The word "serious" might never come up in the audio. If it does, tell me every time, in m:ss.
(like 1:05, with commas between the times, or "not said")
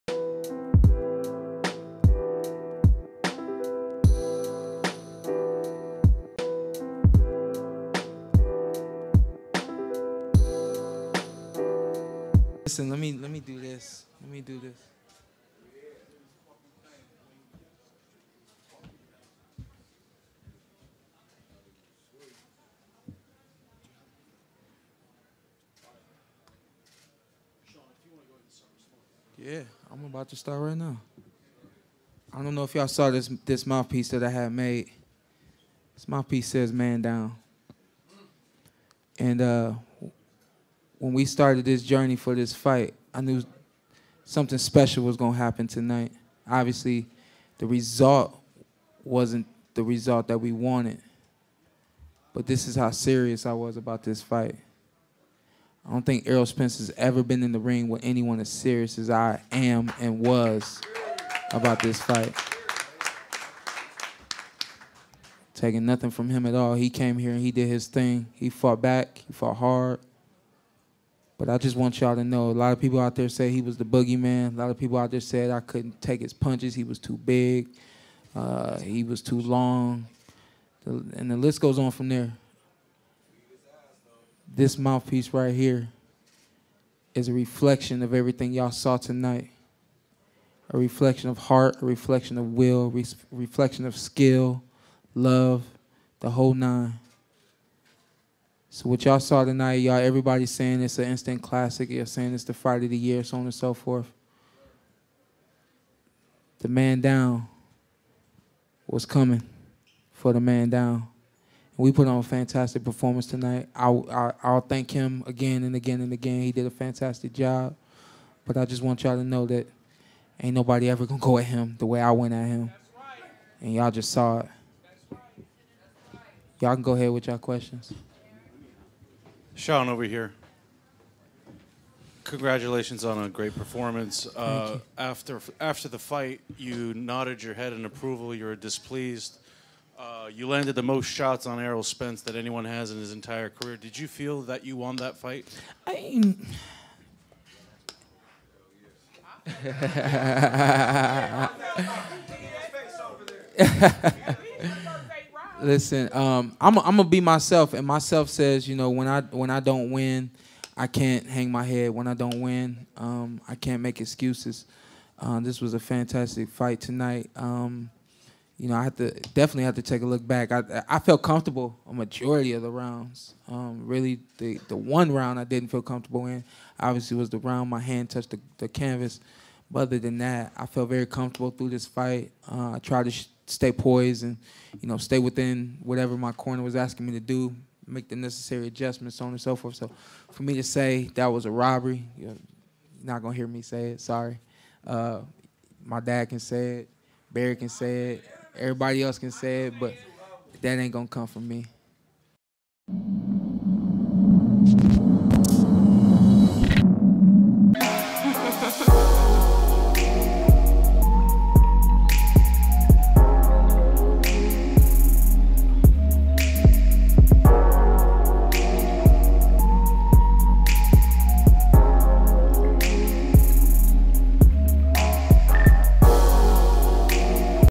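0:52, 0:58.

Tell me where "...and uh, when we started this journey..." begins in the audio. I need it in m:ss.
0:39.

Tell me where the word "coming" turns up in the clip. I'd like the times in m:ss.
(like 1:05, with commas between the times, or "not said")
1:49.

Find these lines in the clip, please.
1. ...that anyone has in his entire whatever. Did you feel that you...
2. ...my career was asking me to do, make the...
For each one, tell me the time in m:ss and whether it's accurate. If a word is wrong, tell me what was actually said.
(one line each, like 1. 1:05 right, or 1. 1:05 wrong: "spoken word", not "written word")
1. 2:22 wrong: "career", not "whatever"
2. 3:06 wrong: "corner", not "career".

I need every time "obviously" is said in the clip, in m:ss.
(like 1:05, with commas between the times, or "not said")
0:46, 2:56.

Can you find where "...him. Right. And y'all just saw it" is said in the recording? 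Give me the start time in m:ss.
2:02.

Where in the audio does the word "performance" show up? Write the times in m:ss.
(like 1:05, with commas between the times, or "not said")
1:52, 2:13.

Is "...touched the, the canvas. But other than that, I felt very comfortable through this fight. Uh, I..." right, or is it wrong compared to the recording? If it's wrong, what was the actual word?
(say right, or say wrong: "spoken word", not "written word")
right.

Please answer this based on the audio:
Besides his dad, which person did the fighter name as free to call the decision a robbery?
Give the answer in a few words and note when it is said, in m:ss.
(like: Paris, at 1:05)
Barry, at 3:17.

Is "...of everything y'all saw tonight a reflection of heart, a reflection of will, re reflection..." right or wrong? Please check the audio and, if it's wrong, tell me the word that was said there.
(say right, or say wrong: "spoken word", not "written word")
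right.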